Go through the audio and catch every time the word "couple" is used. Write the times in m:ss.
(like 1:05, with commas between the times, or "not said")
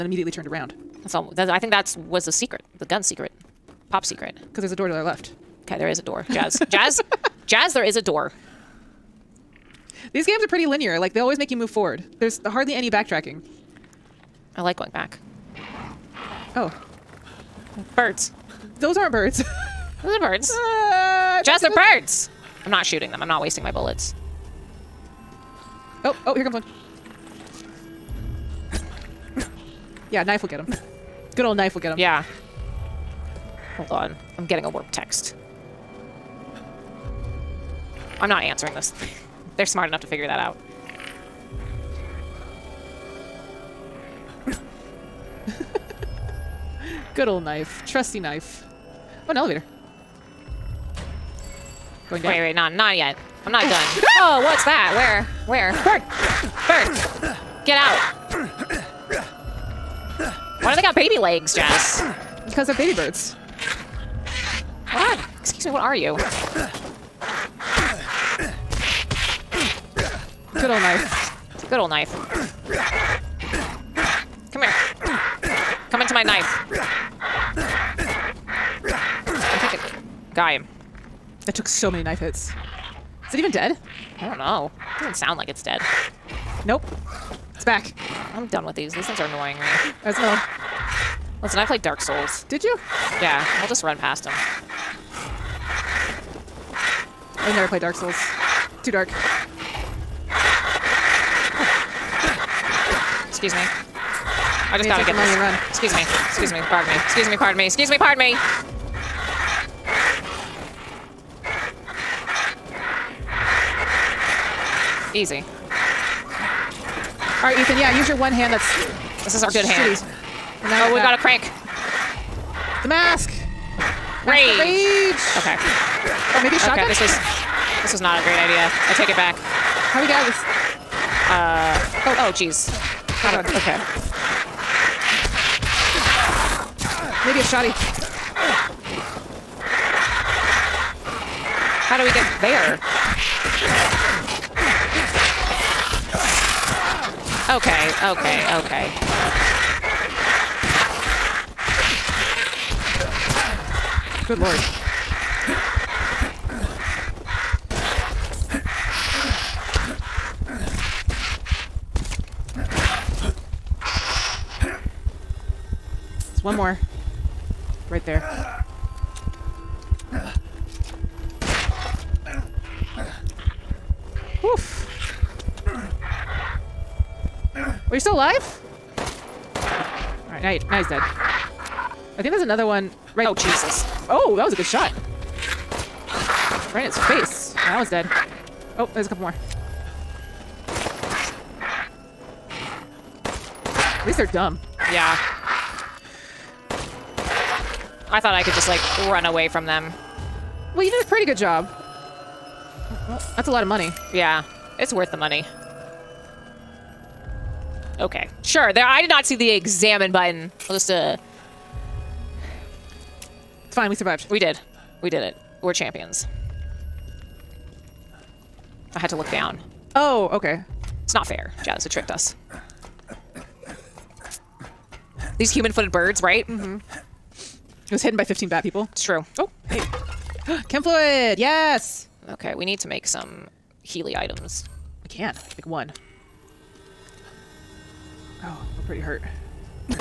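3:09.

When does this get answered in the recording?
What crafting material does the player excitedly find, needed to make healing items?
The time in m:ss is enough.
3:50.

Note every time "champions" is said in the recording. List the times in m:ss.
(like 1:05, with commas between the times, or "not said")
3:35.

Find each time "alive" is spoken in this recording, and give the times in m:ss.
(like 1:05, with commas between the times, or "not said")
2:58.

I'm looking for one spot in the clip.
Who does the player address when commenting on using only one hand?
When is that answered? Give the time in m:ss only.
1:57.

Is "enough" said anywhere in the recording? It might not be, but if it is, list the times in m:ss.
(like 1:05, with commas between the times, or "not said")
0:39.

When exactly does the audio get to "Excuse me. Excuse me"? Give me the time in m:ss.
1:45.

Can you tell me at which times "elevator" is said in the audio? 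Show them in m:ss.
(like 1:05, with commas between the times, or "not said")
0:49.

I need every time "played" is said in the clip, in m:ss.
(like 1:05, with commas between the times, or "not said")
1:31, 1:37.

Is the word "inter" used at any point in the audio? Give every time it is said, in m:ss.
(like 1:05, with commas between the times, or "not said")
not said.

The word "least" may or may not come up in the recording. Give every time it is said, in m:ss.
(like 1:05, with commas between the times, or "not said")
3:14.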